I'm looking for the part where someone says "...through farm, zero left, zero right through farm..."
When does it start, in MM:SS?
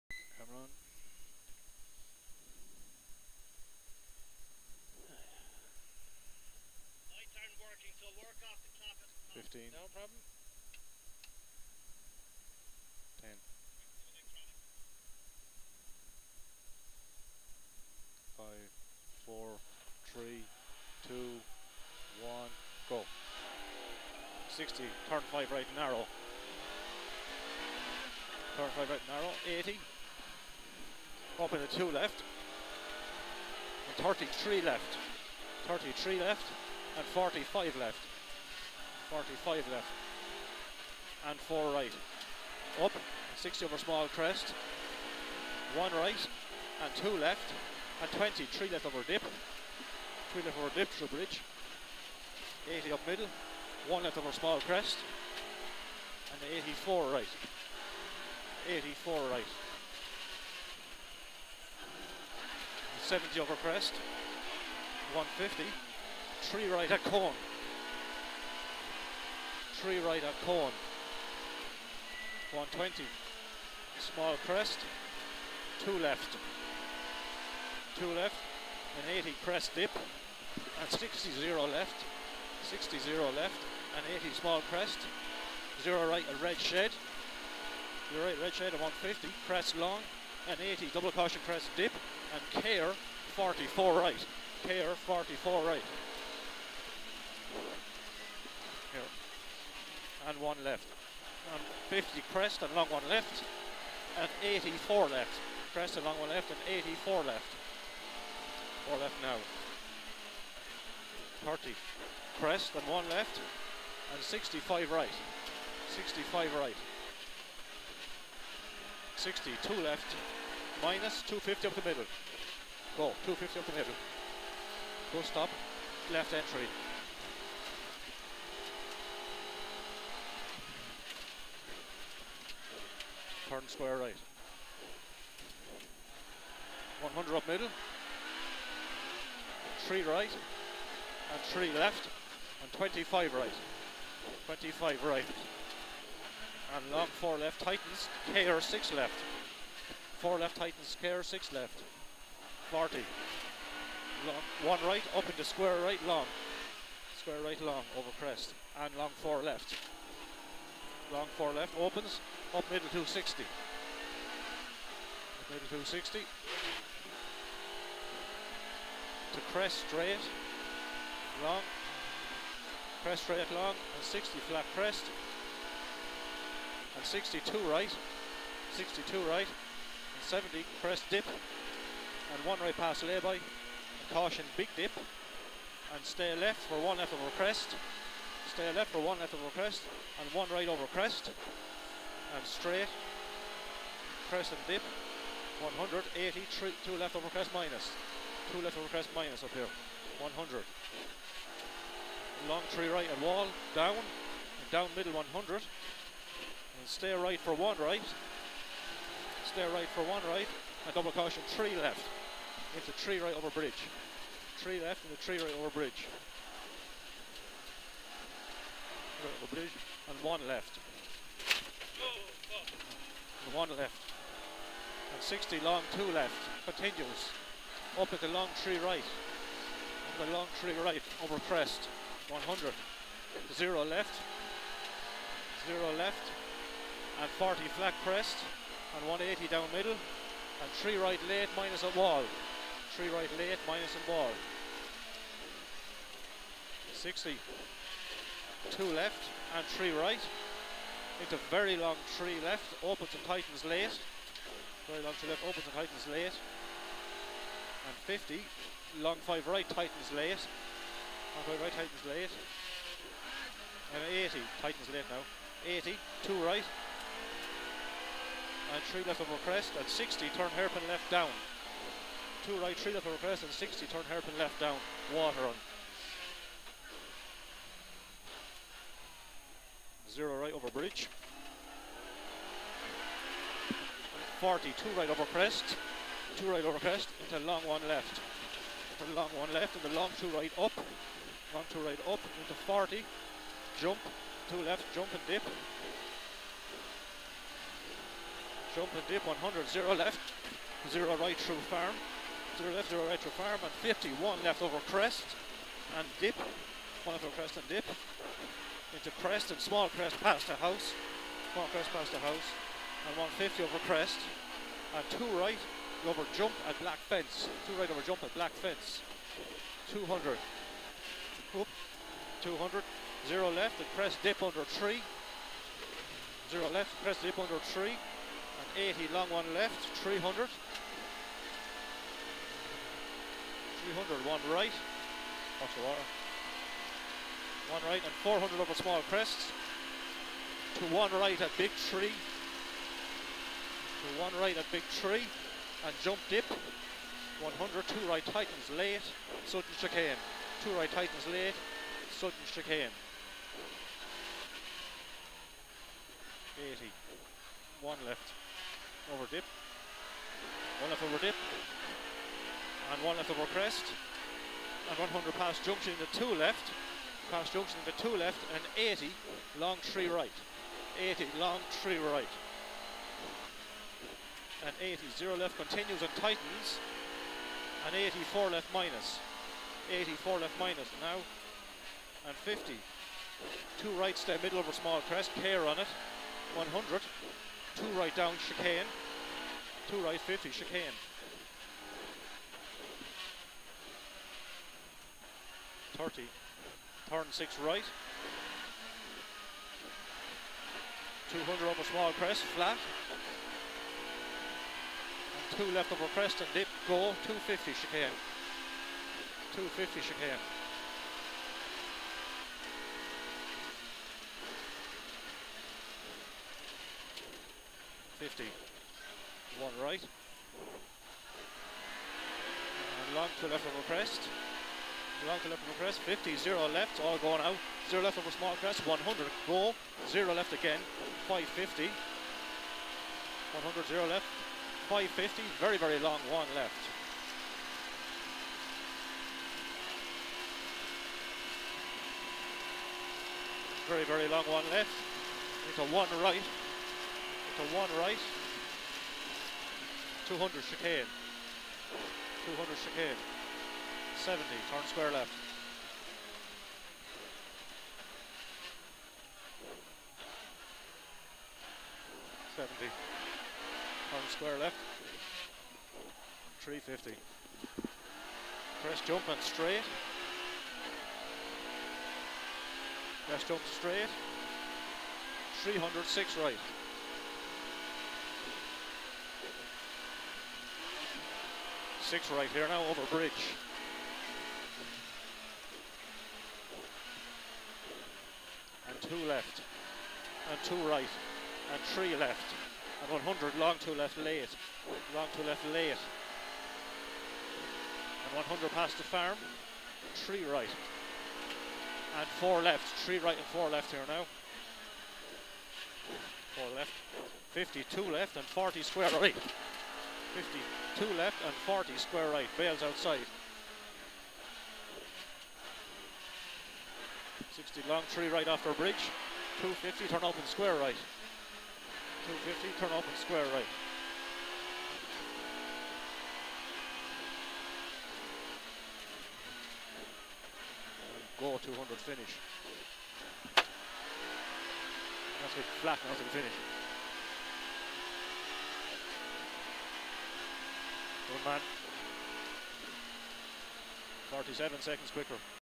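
05:01.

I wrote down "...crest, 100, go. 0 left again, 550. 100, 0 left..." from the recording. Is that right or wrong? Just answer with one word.
right.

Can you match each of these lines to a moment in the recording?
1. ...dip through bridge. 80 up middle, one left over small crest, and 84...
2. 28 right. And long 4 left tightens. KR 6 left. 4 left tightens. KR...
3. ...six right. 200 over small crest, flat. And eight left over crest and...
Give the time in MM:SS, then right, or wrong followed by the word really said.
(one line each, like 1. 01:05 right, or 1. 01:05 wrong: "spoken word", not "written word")
1. 00:50 right
2. 02:24 wrong: "25", not "28"
3. 06:37 wrong: "two", not "eight".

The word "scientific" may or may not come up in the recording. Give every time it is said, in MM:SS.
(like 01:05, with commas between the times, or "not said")
not said.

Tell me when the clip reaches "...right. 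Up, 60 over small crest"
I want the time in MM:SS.
00:41.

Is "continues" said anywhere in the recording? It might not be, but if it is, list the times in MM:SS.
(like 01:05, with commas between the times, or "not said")
03:46, 06:15.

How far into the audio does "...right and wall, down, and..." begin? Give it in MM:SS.
03:22.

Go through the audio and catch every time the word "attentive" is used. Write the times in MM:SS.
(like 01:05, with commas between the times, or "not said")
not said.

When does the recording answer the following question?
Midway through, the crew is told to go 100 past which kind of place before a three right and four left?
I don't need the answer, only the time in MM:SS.
08:18.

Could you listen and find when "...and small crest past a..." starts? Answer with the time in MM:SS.
05:09.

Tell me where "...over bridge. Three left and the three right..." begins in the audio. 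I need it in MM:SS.
03:33.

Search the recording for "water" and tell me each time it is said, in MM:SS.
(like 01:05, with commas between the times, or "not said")
04:35, 05:35.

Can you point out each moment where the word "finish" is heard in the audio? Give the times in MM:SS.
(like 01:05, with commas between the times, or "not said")
08:51, 08:56.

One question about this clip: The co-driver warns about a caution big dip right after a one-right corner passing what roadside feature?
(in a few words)
lay-by.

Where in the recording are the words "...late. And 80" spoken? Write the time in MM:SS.
04:22.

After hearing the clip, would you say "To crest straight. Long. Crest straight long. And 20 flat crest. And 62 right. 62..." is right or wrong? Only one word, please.
wrong.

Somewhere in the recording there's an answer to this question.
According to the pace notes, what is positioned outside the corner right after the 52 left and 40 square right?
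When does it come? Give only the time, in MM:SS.
08:32.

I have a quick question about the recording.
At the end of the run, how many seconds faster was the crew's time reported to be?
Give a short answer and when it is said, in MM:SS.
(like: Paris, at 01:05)
47, at 09:04.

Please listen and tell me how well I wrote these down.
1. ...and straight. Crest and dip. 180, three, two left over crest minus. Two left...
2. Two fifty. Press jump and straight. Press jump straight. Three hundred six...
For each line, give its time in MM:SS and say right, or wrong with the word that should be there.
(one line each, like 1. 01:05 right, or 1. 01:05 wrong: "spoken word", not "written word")
1. 03:12 right
2. 07:46 wrong: "Three", not "Two".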